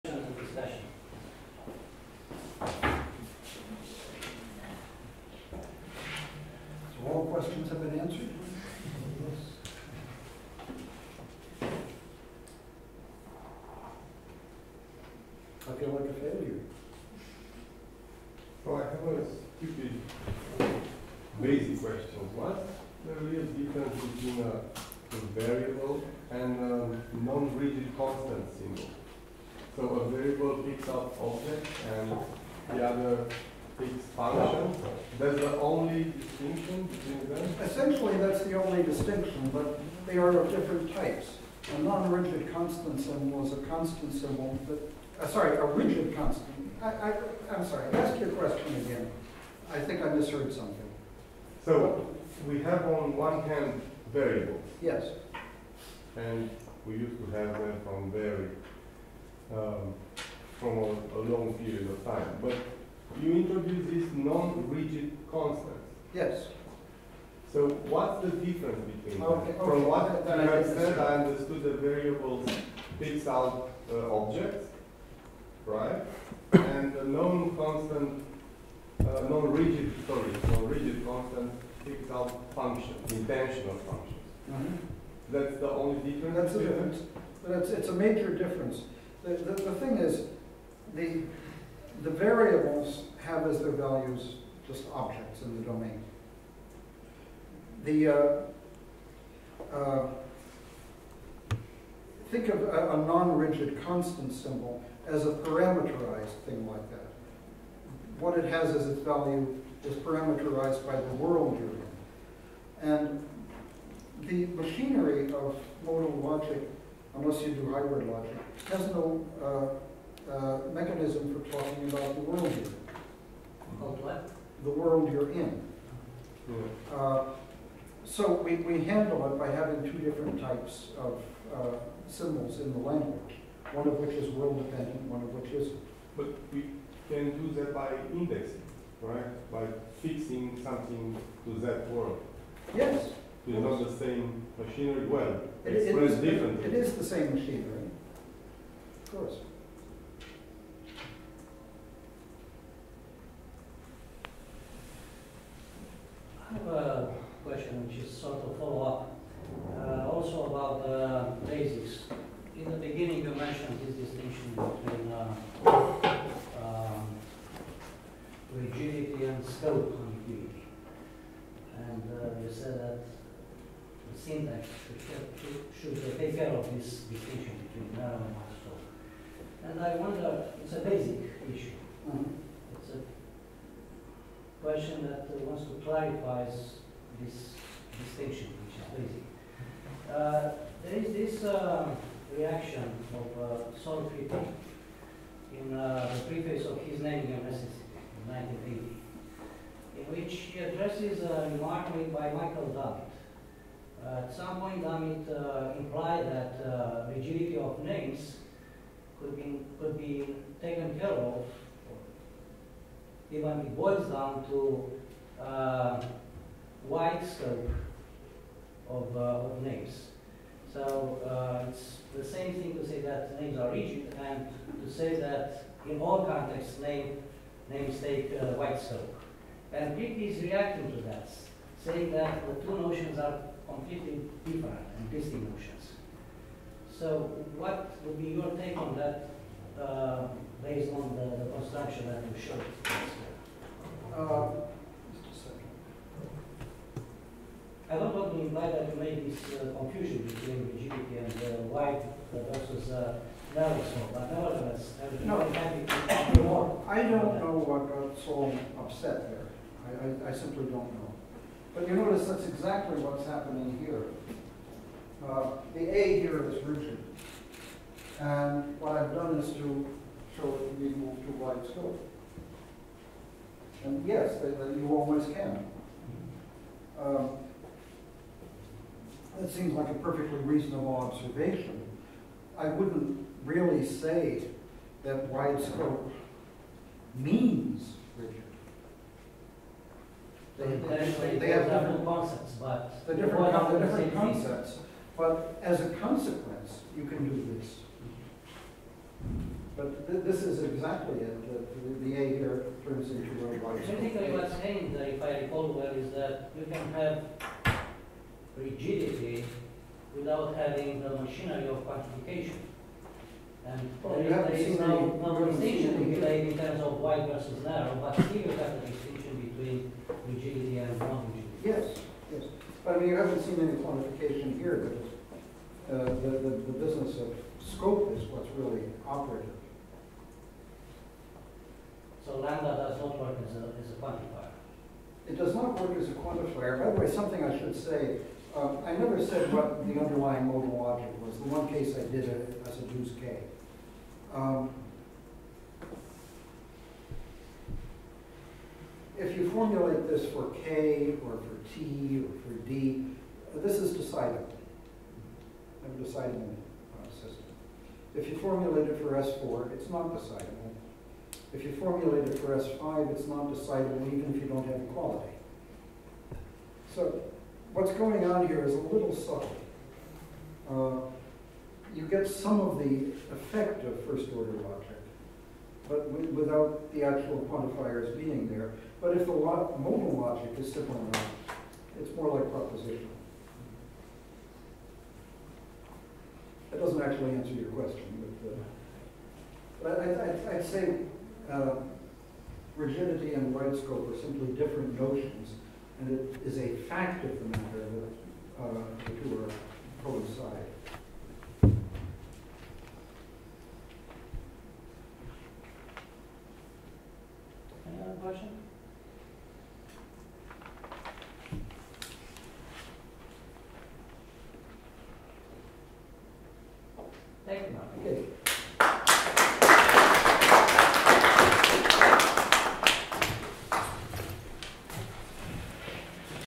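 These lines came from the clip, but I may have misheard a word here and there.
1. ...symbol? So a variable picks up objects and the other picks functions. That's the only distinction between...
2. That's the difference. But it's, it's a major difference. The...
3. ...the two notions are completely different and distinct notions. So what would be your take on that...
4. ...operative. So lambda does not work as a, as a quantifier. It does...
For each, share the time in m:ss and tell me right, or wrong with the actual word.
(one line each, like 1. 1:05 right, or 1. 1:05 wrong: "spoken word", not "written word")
1. 0:28 right
2. 1:26 right
3. 3:52 right
4. 5:29 right.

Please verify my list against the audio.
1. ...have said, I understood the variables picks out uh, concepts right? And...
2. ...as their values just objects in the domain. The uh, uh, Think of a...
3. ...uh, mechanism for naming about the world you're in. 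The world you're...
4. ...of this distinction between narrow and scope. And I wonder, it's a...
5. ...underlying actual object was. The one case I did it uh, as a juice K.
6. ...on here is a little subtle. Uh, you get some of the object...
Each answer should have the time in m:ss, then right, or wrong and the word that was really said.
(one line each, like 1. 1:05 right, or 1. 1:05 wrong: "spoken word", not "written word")
1. 1:10 wrong: "objects", not "concepts"
2. 1:33 right
3. 2:00 wrong: "talking", not "naming"
4. 2:56 right
5. 5:39 wrong: "modal", not "actual"
6. 6:08 wrong: "effect", not "object".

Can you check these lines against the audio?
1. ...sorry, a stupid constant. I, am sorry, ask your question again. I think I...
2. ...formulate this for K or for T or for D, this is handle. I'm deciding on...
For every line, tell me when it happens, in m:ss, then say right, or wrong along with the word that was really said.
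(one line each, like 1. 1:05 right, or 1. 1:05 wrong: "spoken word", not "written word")
1. 0:45 wrong: "rigid", not "stupid"
2. 5:49 wrong: "decidable", not "handle".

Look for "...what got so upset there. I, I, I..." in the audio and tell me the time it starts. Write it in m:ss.
4:17.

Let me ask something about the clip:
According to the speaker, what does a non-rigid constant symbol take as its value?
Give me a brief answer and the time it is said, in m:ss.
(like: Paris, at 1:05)
intensional functions, at 1:23.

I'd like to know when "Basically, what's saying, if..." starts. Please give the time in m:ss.
5:04.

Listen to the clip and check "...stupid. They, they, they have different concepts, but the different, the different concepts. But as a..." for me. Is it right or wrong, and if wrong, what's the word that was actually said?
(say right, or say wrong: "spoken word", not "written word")
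wrong: "rigid", not "stupid".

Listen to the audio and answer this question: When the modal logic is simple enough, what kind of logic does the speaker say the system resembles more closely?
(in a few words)
propositional.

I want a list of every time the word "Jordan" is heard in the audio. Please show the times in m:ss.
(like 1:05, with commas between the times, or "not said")
not said.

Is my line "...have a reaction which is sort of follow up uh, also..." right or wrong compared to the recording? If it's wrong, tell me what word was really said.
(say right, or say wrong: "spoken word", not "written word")
wrong: "question", not "reaction".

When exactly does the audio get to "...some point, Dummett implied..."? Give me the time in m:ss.
3:24.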